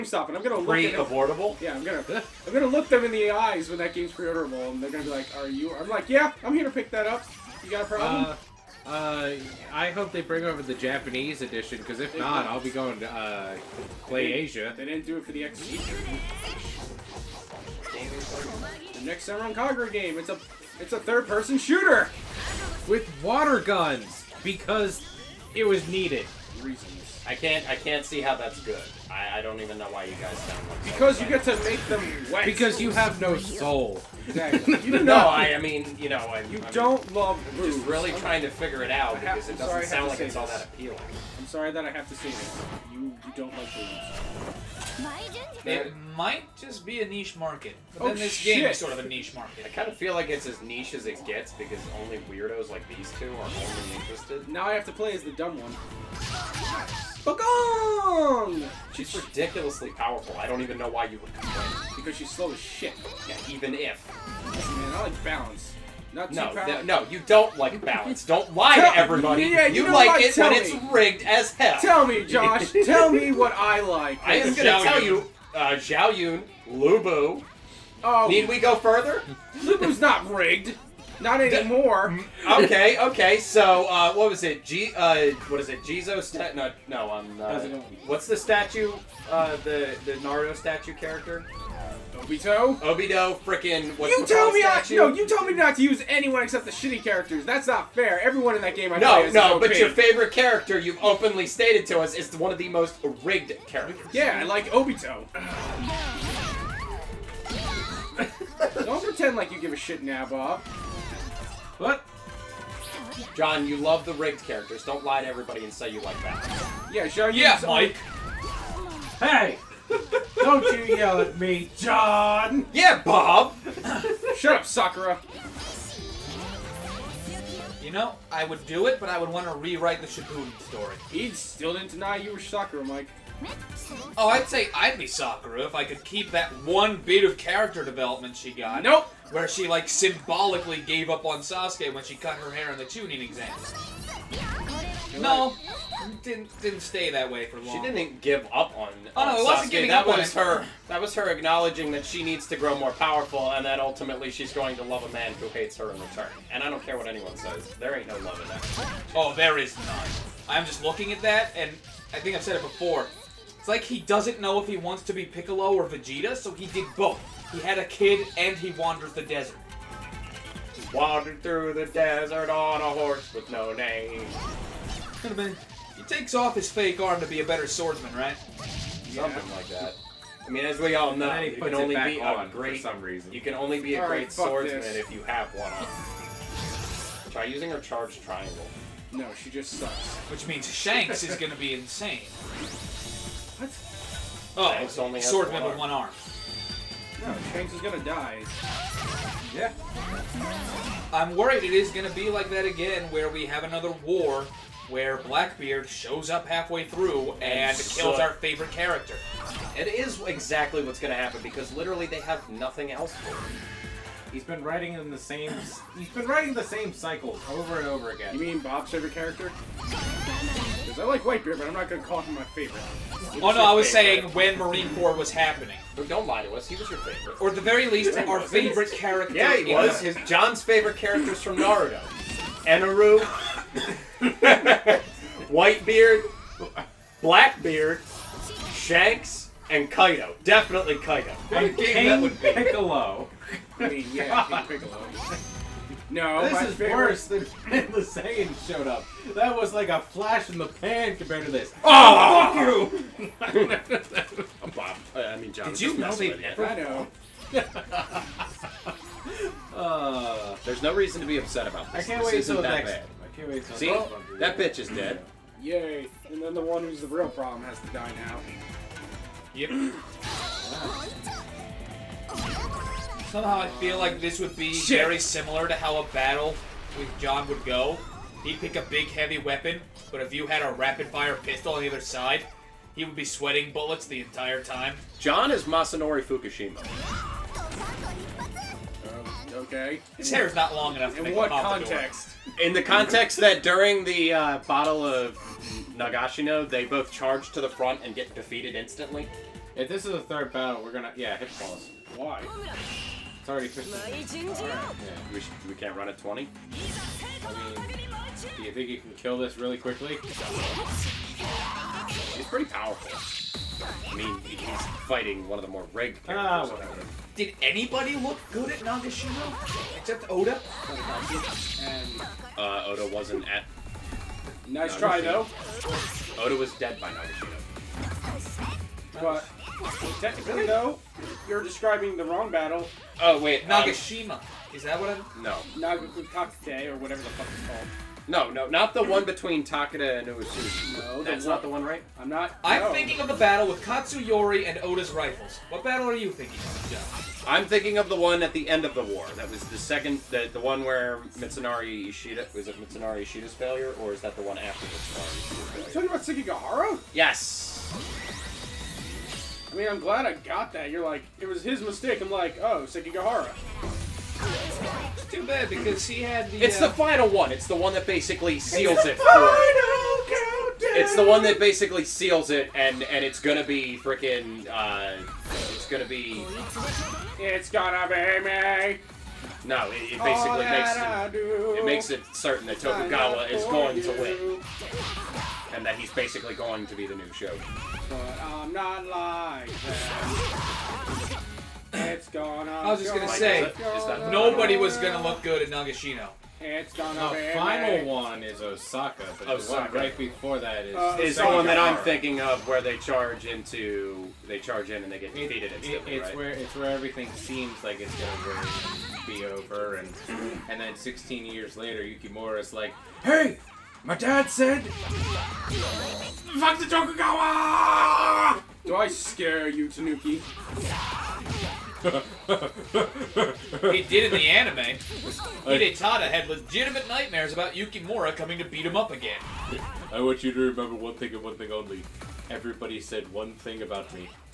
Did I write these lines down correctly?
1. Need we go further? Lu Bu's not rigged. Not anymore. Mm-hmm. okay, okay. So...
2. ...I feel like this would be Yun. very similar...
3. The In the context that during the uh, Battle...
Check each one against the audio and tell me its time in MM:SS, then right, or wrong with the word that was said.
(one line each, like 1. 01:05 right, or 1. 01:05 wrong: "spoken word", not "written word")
1. 01:18 right
2. 04:33 wrong: "Shit", not "Yun"
3. 04:52 right.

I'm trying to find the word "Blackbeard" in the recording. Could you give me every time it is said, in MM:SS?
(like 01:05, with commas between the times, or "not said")
03:25, 03:57.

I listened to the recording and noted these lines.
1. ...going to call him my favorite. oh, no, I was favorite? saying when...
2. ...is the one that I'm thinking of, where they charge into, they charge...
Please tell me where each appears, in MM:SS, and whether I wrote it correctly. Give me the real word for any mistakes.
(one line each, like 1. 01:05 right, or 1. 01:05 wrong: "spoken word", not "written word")
1. 03:41 right
2. 06:41 right.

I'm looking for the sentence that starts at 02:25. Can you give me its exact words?
No, didn't didn't stay that way for long.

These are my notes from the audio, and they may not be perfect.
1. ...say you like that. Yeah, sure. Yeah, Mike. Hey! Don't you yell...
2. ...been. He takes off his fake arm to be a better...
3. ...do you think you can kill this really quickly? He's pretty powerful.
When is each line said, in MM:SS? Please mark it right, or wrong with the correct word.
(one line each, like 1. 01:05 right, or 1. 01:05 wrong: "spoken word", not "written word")
1. 01:55 right
2. 02:55 right
3. 05:08 right.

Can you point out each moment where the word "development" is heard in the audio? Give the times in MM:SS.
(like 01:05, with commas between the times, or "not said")
02:17.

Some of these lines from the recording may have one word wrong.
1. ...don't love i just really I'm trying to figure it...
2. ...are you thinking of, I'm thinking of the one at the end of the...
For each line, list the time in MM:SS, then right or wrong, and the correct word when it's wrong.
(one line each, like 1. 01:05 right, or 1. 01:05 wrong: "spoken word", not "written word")
1. 00:36 right
2. 05:46 right.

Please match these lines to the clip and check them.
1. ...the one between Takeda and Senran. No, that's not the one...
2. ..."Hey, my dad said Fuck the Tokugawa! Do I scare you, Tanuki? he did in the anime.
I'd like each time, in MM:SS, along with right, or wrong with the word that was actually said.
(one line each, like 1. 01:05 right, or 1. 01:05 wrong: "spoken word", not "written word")
1. 05:38 wrong: "Uesugi", not "Senran"
2. 06:53 right.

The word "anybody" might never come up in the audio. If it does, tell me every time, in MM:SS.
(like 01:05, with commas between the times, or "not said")
05:17.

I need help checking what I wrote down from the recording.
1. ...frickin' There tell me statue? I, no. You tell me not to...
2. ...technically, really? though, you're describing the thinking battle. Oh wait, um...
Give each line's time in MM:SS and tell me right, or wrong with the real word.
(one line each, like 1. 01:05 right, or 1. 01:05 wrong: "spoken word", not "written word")
1. 01:33 wrong: "You", not "There"
2. 05:30 wrong: "wrong", not "thinking".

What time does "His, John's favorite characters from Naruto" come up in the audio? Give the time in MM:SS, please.
03:50.